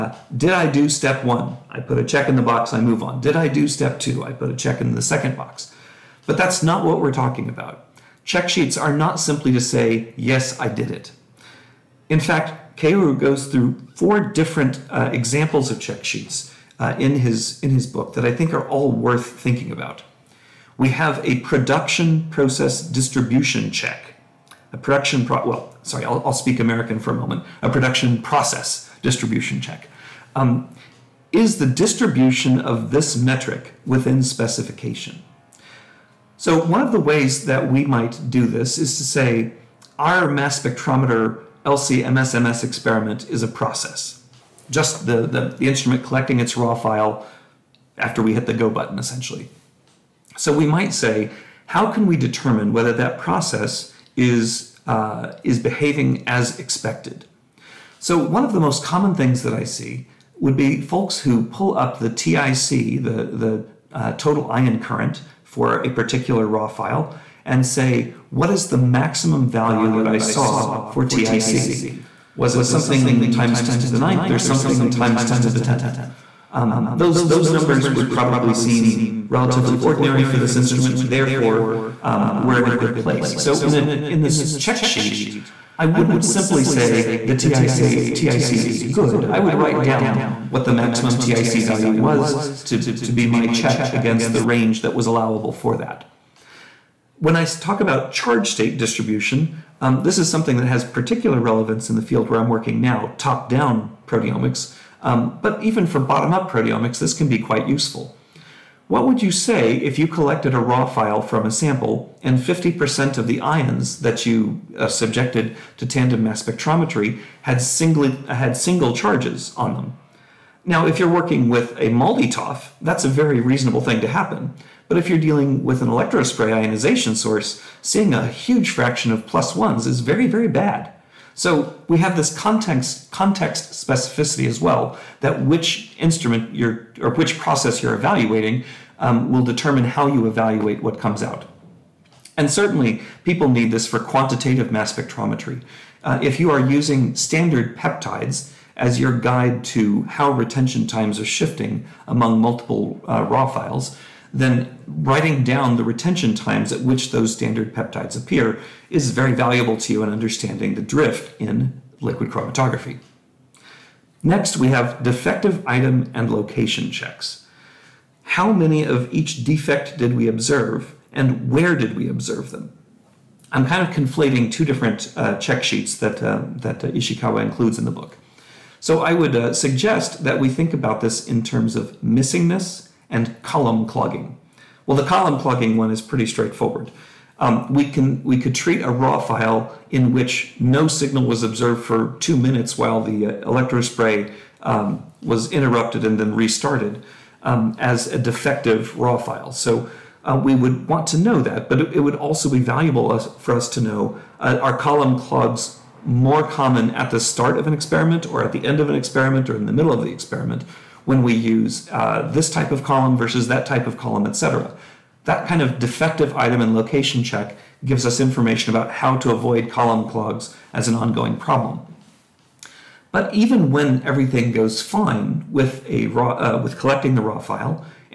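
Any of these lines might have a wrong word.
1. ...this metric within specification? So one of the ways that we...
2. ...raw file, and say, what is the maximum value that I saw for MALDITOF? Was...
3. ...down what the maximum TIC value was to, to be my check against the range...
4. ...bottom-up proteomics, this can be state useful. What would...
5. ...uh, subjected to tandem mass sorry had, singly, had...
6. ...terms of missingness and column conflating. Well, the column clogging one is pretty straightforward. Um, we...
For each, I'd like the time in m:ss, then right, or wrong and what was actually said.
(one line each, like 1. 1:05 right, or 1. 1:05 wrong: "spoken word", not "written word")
1. 0:32 right
2. 1:06 wrong: "TIC", not "MALDITOF"
3. 1:29 right
4. 1:45 wrong: "quite", not "state"
5. 1:54 wrong: "spectrometry", not "sorry"
6. 3:01 wrong: "clogging", not "conflating".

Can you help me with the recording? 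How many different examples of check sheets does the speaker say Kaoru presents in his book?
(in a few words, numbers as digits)
4.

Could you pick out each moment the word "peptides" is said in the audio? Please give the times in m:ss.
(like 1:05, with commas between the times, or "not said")
2:27, 2:37.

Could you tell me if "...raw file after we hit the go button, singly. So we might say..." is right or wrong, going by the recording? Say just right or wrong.
wrong.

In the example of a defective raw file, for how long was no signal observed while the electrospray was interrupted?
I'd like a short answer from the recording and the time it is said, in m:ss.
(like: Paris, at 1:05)
2 minutes, at 3:12.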